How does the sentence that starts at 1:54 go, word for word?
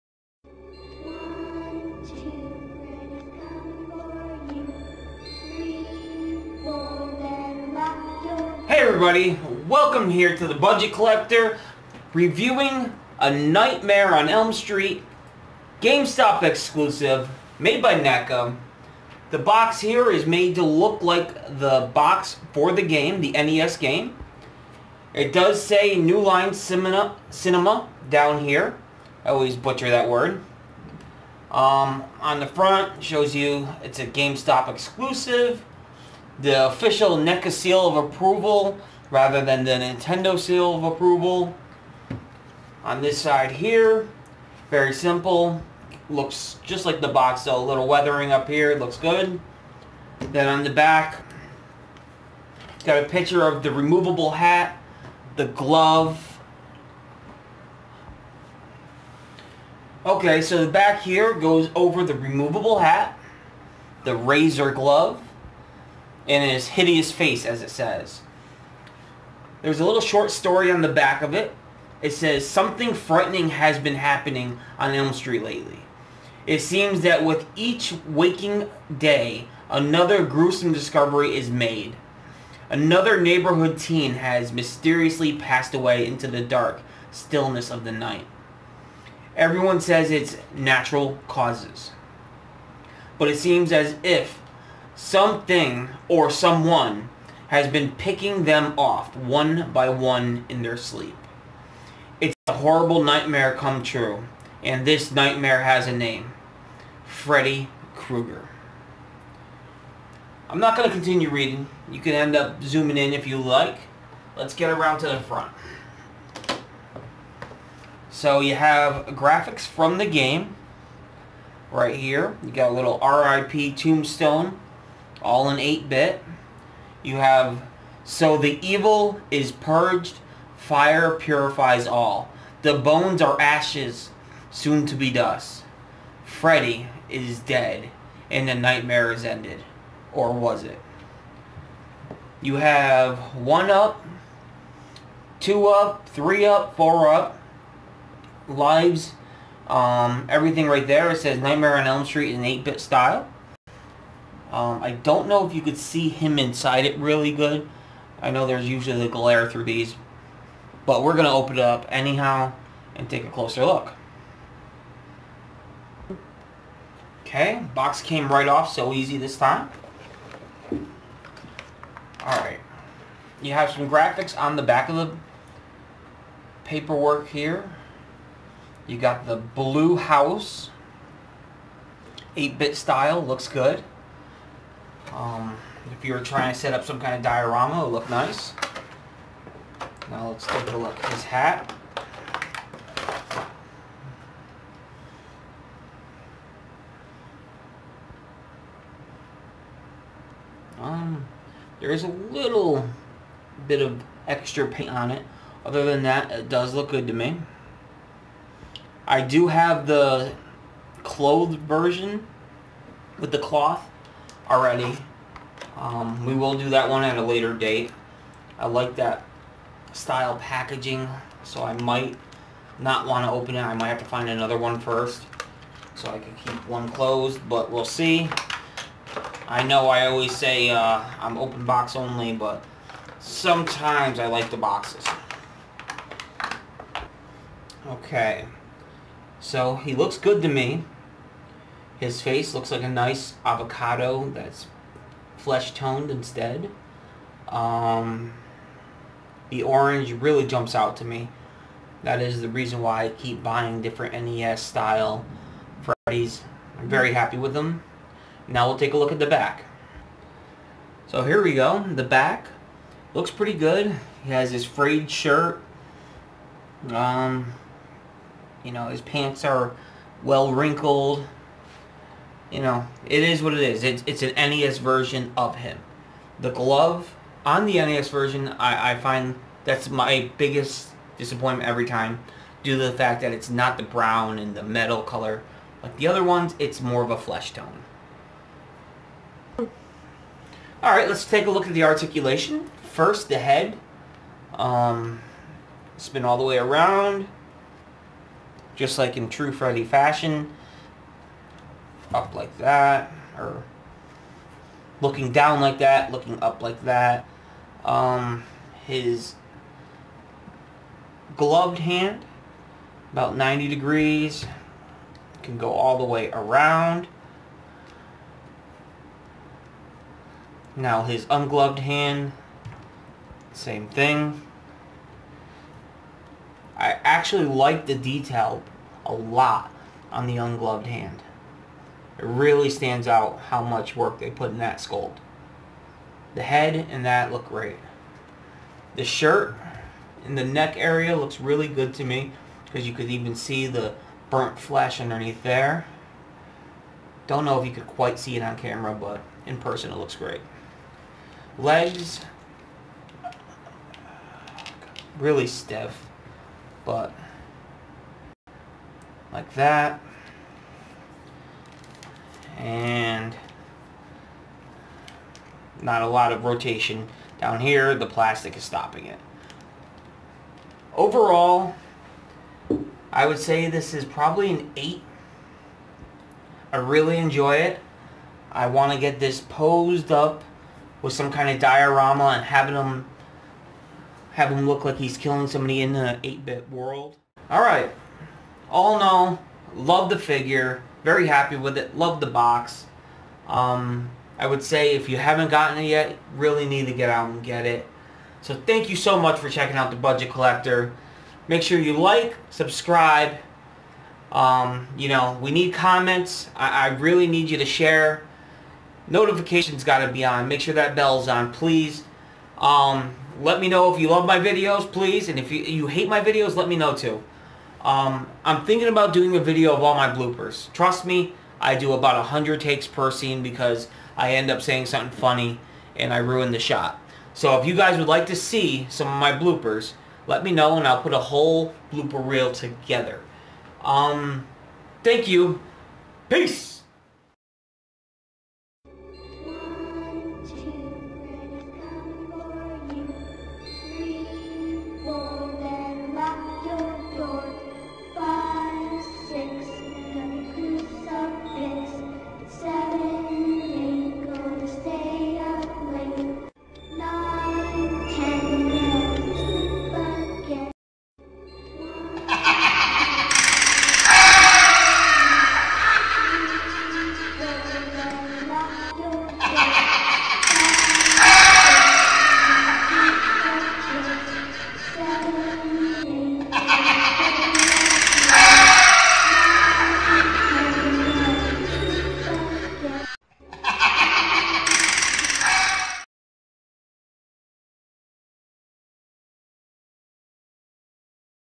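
Let's get around to the front.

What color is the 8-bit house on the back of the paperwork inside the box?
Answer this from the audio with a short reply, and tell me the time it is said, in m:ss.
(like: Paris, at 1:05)
Blue, at 2:59.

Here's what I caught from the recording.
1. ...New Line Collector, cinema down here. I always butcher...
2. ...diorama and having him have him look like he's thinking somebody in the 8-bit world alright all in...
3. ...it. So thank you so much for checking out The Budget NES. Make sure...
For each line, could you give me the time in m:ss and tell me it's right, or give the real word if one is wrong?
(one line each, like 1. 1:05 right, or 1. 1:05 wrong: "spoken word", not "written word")
1. 0:25 wrong: "Cinema", not "Collector"
2. 6:21 wrong: "killing", not "thinking"
3. 6:37 wrong: "Collector", not "NES".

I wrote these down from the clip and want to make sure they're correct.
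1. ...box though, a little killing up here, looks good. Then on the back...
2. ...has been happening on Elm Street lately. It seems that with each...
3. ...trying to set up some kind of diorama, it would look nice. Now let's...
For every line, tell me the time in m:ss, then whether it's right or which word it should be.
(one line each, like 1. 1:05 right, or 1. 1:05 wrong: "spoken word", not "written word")
1. 0:47 wrong: "weathering", not "killing"
2. 1:13 right
3. 3:06 right.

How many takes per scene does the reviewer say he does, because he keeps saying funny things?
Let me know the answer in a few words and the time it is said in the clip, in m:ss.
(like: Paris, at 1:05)
100, at 7:01.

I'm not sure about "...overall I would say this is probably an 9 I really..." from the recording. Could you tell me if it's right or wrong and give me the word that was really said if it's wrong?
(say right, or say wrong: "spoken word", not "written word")
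wrong: "8", not "9".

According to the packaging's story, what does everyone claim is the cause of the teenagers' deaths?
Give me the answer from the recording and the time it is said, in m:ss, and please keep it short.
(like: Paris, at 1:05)
Natural causes, at 1:30.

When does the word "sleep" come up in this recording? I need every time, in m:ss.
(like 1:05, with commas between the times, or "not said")
1:40.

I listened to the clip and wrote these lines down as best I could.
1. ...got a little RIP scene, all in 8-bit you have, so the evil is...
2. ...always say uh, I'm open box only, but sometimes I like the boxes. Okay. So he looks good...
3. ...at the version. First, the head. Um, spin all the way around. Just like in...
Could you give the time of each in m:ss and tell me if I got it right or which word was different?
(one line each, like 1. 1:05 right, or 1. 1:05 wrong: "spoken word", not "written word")
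1. 2:02 wrong: "tombstone", not "scene"
2. 3:50 right
3. 4:51 wrong: "articulation", not "version".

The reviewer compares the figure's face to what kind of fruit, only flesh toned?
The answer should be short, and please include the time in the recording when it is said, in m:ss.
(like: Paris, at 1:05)
Avocado, at 4:03.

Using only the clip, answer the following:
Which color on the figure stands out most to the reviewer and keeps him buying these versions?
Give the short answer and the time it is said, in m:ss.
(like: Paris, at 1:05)
Orange, at 4:09.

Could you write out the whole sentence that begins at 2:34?
Um, I don't know if you could see him inside it really good.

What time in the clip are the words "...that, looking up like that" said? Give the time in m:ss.
5:05.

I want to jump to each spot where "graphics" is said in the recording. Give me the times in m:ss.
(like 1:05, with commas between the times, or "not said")
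1:59, 2:53.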